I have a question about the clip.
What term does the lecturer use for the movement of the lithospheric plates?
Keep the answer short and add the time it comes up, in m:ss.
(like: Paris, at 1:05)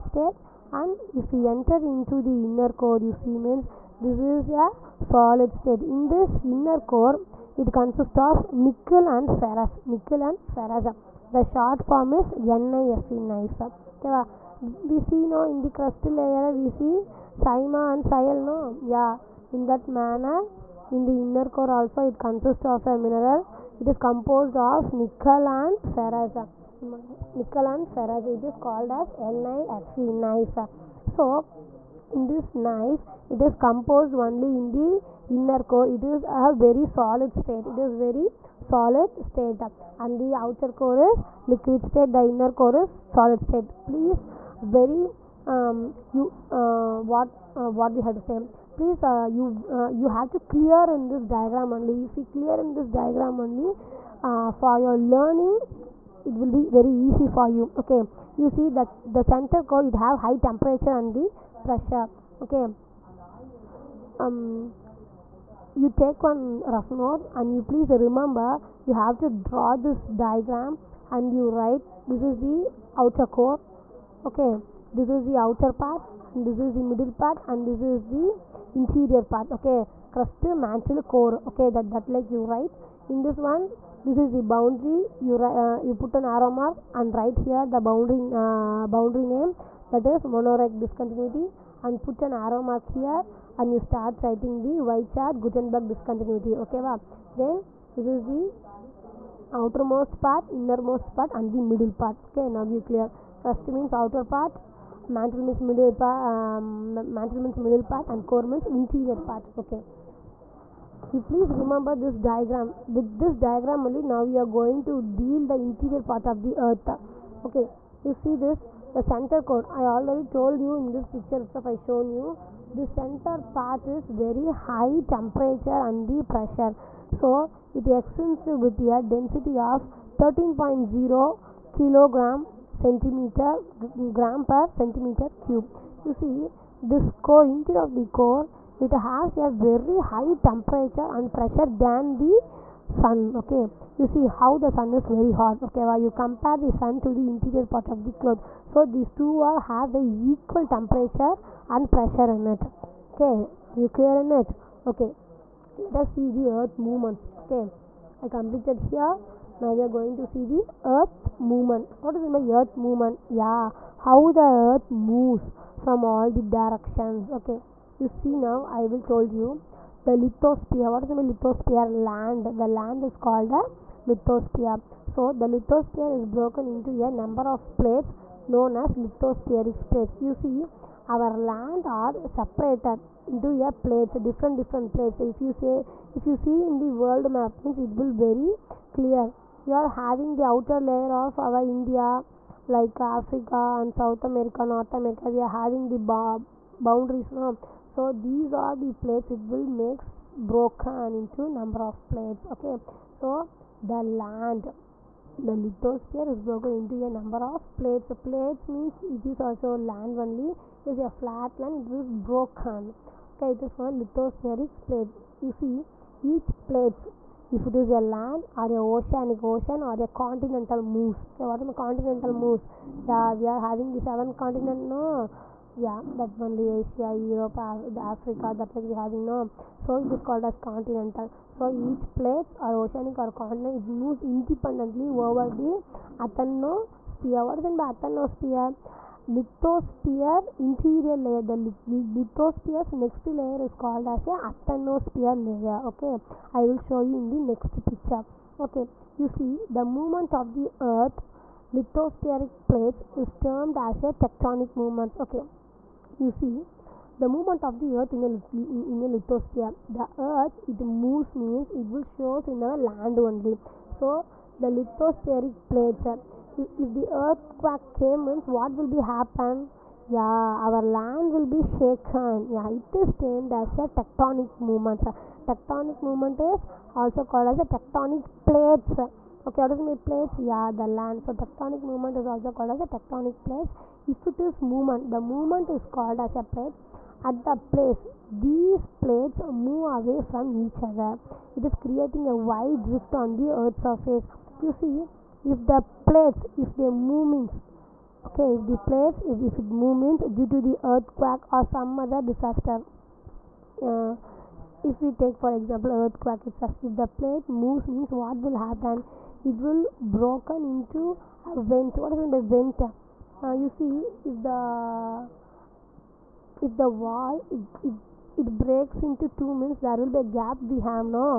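tectonic movements, at 4:14.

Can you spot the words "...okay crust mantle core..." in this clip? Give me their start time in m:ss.
1:19.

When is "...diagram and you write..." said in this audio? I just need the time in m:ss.
1:10.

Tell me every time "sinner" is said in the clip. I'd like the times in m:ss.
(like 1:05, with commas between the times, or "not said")
not said.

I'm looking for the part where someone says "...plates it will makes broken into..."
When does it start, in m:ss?
3:18.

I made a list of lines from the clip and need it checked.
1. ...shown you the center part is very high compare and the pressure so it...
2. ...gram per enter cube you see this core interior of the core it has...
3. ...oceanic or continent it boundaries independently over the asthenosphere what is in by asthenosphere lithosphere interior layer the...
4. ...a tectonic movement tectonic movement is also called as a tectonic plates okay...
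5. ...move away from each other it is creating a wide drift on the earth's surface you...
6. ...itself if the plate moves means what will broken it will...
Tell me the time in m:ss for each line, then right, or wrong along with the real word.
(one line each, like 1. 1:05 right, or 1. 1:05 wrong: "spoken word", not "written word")
1. 2:01 wrong: "temperature", not "compare"
2. 2:14 wrong: "centimeter", not "enter"
3. 3:52 wrong: "moves", not "boundaries"
4. 4:33 right
5. 4:49 right
6. 5:06 wrong: "happen", not "broken".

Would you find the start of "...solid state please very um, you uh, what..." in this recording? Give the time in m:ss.
0:42.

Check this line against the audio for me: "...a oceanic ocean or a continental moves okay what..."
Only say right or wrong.
right.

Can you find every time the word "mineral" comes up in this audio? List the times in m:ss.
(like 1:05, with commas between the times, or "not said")
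0:22.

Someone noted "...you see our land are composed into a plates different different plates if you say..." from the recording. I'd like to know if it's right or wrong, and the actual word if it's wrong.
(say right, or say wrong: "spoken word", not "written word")
wrong: "separated", not "composed".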